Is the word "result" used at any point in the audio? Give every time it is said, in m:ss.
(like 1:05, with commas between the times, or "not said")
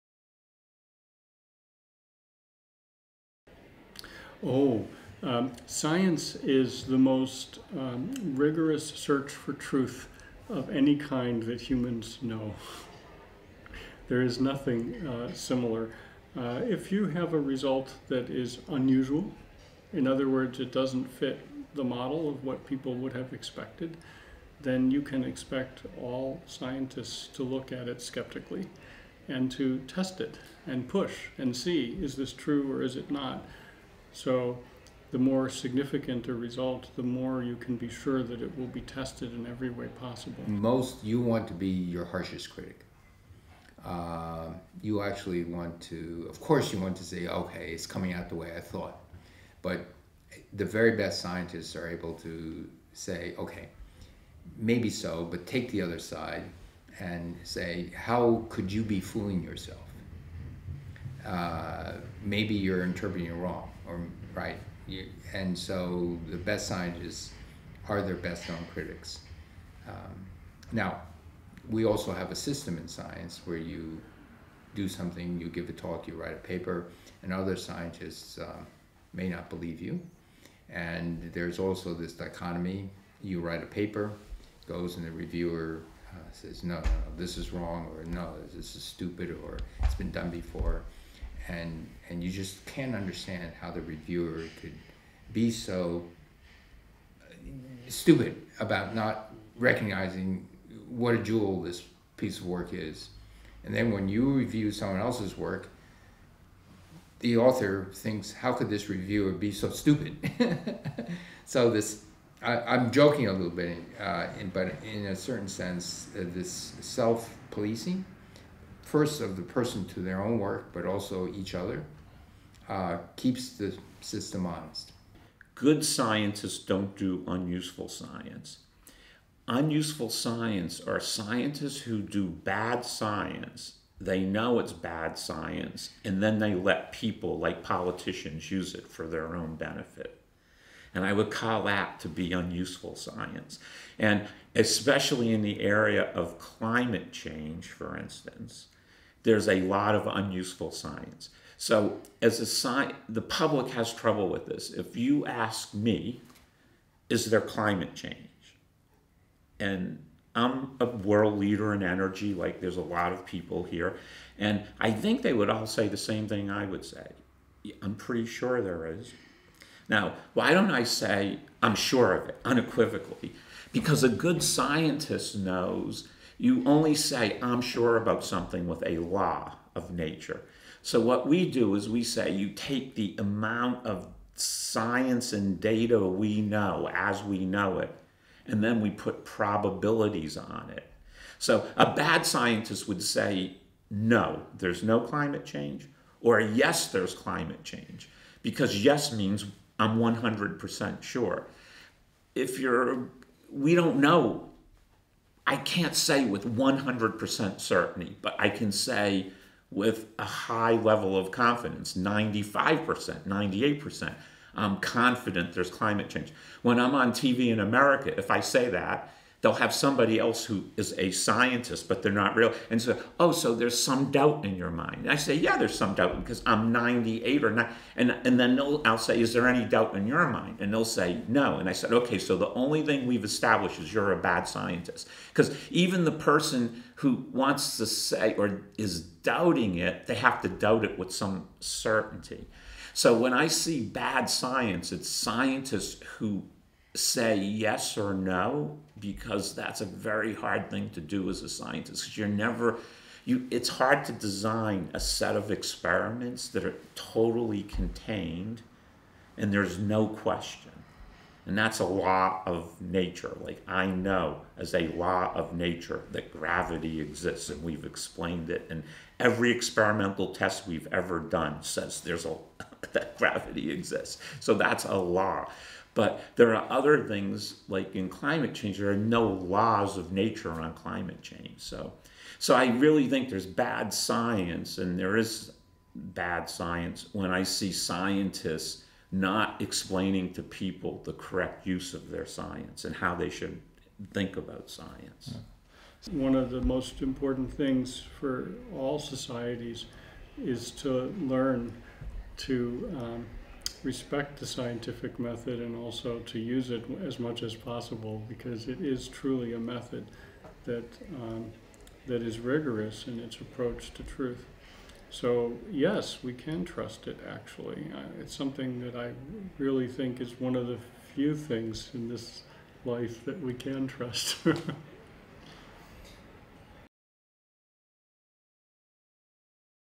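0:17, 0:36.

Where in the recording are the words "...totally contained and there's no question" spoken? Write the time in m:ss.
4:16.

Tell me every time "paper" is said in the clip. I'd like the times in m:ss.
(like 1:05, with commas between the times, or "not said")
1:16, 1:23.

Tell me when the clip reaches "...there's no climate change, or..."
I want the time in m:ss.
3:14.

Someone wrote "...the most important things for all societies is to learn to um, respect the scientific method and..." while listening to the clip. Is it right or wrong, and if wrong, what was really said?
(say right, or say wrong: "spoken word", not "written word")
right.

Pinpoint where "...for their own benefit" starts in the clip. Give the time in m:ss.
2:18.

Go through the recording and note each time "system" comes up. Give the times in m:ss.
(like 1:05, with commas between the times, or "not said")
1:12, 2:04.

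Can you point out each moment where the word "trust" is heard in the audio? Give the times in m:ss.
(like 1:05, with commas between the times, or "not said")
5:16, 5:23.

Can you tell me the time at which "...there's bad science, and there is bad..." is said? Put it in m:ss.
4:43.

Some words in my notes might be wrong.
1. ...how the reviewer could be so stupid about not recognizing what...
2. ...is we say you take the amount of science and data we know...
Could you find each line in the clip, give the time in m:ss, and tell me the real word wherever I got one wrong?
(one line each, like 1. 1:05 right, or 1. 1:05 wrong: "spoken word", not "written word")
1. 1:33 right
2. 3:01 right.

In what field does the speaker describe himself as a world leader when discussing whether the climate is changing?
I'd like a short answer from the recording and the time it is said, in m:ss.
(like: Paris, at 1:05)
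energy, at 2:41.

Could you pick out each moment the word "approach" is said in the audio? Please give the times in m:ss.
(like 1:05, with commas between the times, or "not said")
5:13.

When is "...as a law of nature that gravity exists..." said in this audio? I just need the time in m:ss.
4:24.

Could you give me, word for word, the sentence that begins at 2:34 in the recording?
If you ask me, is there climate change?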